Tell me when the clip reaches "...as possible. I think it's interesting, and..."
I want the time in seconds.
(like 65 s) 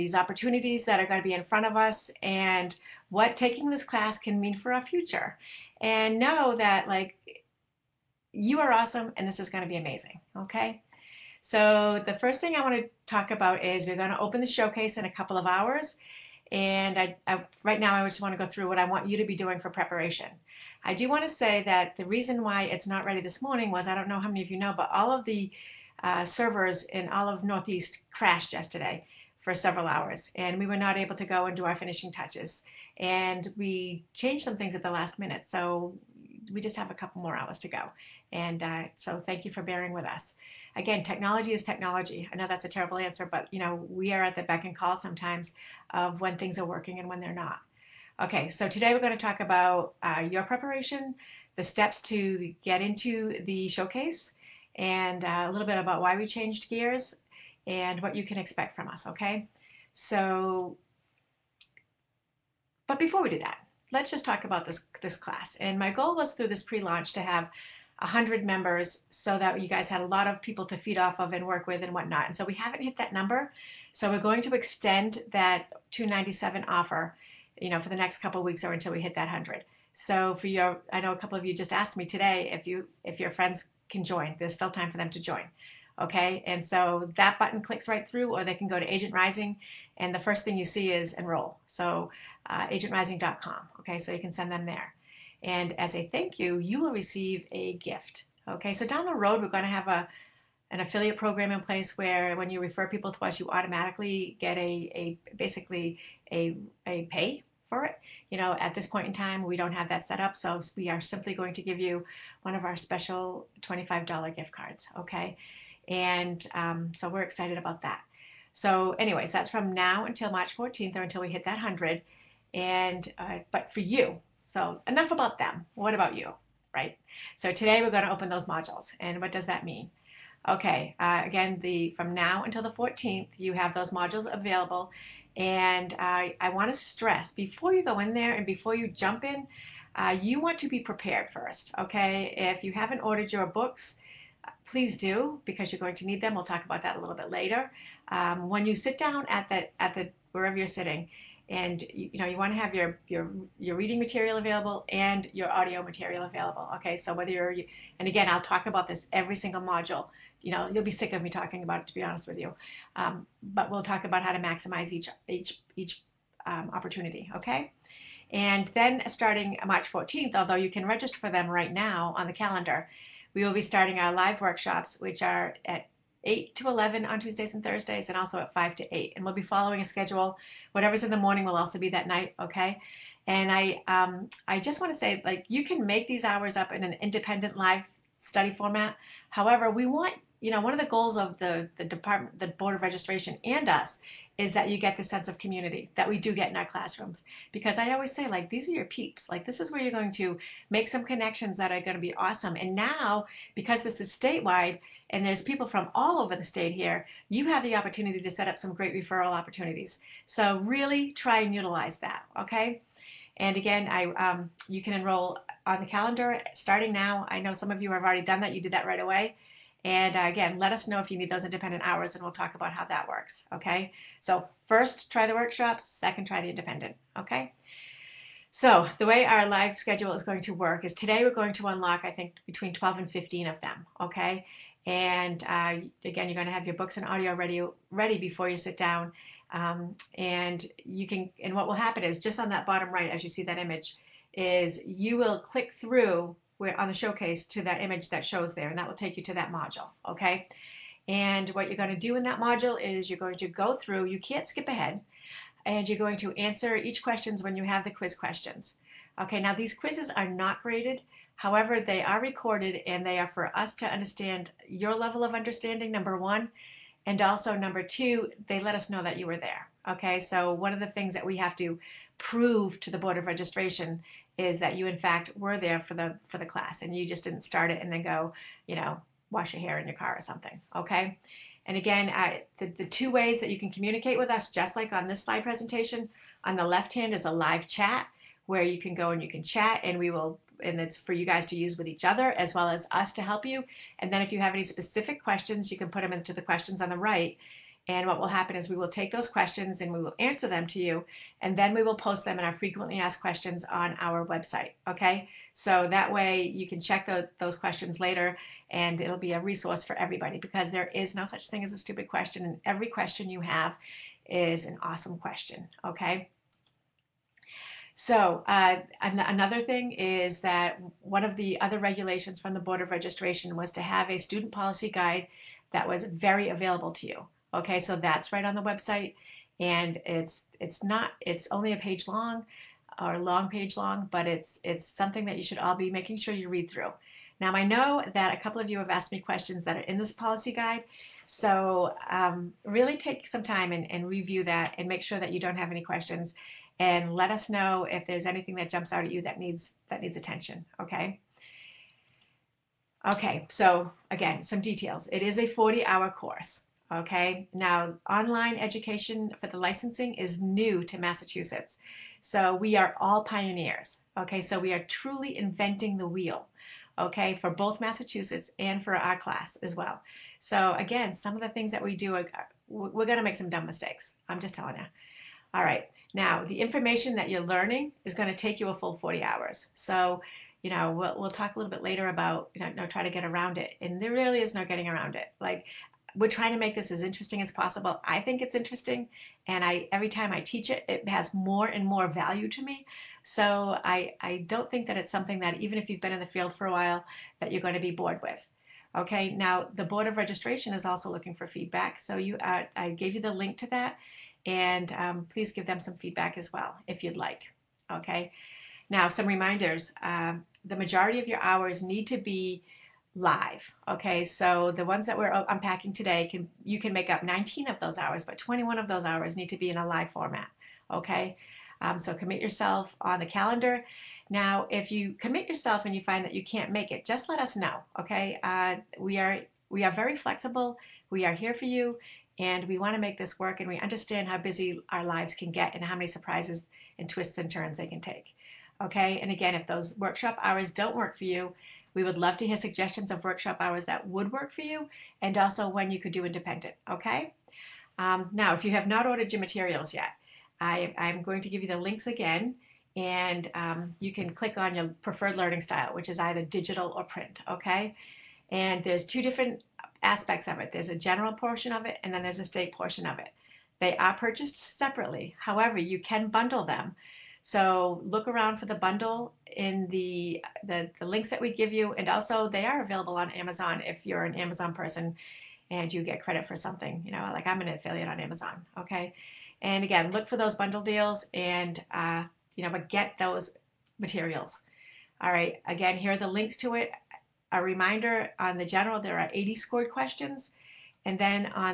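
387 s.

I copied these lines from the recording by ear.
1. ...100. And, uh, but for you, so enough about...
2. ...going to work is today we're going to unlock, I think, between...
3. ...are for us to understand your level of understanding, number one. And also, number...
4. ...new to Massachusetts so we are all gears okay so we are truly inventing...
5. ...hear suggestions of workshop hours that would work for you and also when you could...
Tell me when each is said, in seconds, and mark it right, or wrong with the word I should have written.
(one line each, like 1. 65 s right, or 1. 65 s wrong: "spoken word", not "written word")
1. 121 s right
2. 230 s right
3. 263 s right
4. 360 s wrong: "pioneers", not "gears"
5. 442 s right.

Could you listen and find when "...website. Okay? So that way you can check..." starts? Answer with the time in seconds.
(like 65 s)
304 s.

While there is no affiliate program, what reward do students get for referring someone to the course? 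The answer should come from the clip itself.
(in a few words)
$25 gift card.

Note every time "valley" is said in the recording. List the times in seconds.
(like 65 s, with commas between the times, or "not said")
not said.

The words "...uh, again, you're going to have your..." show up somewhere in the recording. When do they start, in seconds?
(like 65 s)
235 s.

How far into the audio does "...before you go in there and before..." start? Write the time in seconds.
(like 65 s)
137 s.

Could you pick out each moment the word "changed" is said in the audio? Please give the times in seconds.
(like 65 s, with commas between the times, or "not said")
34 s, 56 s.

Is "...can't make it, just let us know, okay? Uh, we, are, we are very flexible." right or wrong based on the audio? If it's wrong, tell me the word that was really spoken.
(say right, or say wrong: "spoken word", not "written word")
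right.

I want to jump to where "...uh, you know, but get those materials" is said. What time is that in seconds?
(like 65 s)
481 s.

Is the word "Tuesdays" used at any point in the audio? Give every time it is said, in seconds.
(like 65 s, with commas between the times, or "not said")
177 s.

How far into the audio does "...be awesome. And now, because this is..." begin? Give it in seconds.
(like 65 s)
202 s.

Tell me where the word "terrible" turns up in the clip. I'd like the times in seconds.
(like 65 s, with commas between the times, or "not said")
42 s.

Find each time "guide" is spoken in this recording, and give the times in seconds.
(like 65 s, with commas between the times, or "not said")
324 s, 340 s.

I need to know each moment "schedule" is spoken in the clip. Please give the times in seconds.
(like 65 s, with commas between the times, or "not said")
179 s, 229 s.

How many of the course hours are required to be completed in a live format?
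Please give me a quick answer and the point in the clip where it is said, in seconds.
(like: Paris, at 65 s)
21, at 418 s.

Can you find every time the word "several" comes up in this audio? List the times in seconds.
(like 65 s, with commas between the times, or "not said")
29 s.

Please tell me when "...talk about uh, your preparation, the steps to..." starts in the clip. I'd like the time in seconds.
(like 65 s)
49 s.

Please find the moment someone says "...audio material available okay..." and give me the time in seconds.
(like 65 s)
155 s.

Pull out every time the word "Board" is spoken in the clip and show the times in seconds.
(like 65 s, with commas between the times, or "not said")
192 s, 272 s, 322 s, 399 s.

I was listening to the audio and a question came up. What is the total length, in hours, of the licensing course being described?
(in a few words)
40 hours.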